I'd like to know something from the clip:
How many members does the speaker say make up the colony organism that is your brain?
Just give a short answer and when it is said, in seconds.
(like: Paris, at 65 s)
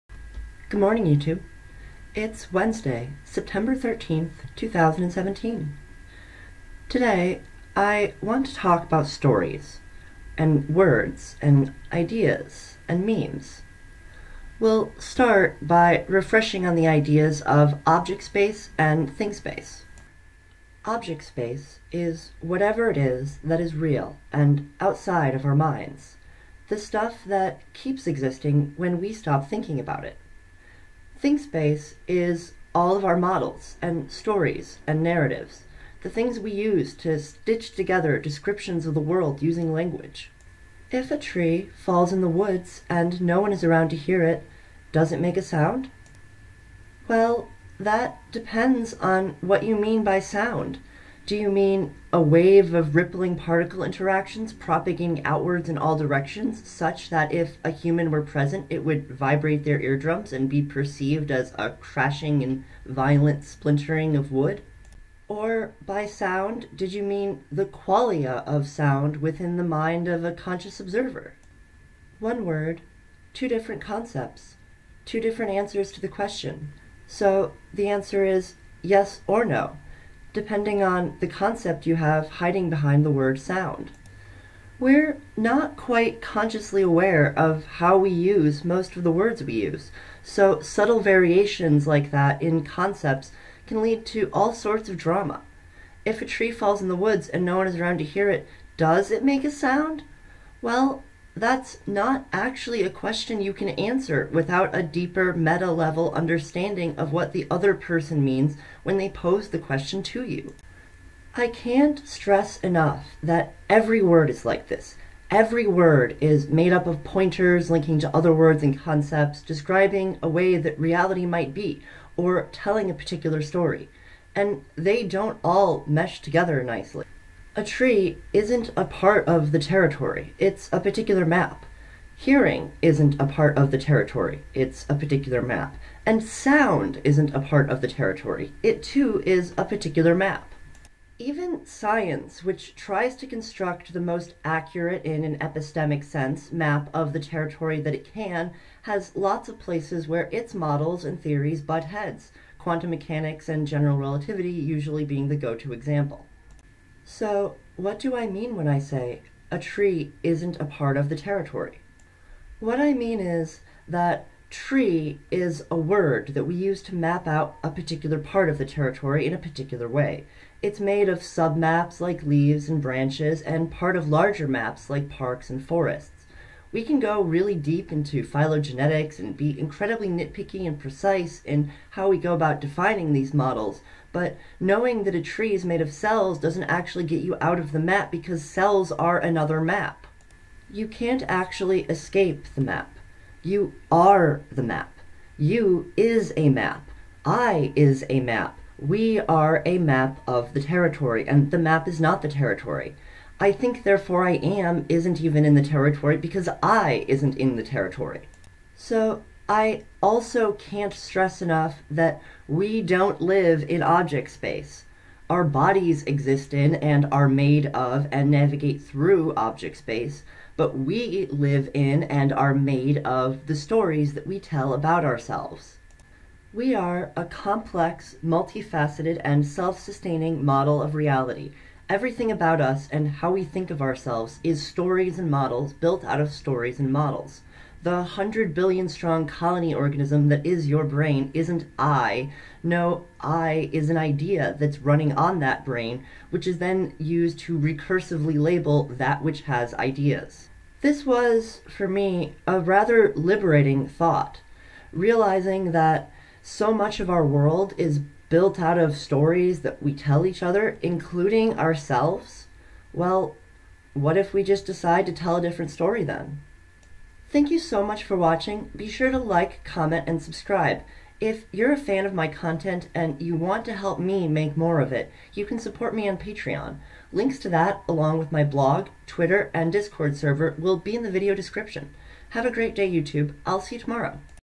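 100 billion, at 238 s.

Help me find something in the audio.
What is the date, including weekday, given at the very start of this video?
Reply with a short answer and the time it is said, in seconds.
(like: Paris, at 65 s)
Wednesday, September 13th, 2017, at 2 s.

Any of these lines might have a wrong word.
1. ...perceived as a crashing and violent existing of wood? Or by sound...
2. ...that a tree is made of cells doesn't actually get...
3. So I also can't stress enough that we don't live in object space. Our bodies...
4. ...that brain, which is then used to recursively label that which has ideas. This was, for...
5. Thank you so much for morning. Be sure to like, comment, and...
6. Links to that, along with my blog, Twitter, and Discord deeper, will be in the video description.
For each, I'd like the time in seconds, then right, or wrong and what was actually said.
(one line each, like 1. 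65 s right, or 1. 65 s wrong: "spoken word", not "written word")
1. 60 s wrong: "splintering", not "existing"
2. 185 s right
3. 208 s right
4. 245 s right
5. 267 s wrong: "watching", not "morning"
6. 277 s wrong: "server", not "deeper".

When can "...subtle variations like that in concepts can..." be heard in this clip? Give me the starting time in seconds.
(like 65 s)
90 s.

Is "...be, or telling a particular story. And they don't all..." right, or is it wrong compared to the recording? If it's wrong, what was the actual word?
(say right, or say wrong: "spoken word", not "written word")
right.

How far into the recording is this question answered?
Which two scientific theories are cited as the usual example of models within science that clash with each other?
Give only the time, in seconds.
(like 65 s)
152 s.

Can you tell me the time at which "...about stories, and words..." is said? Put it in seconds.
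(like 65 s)
8 s.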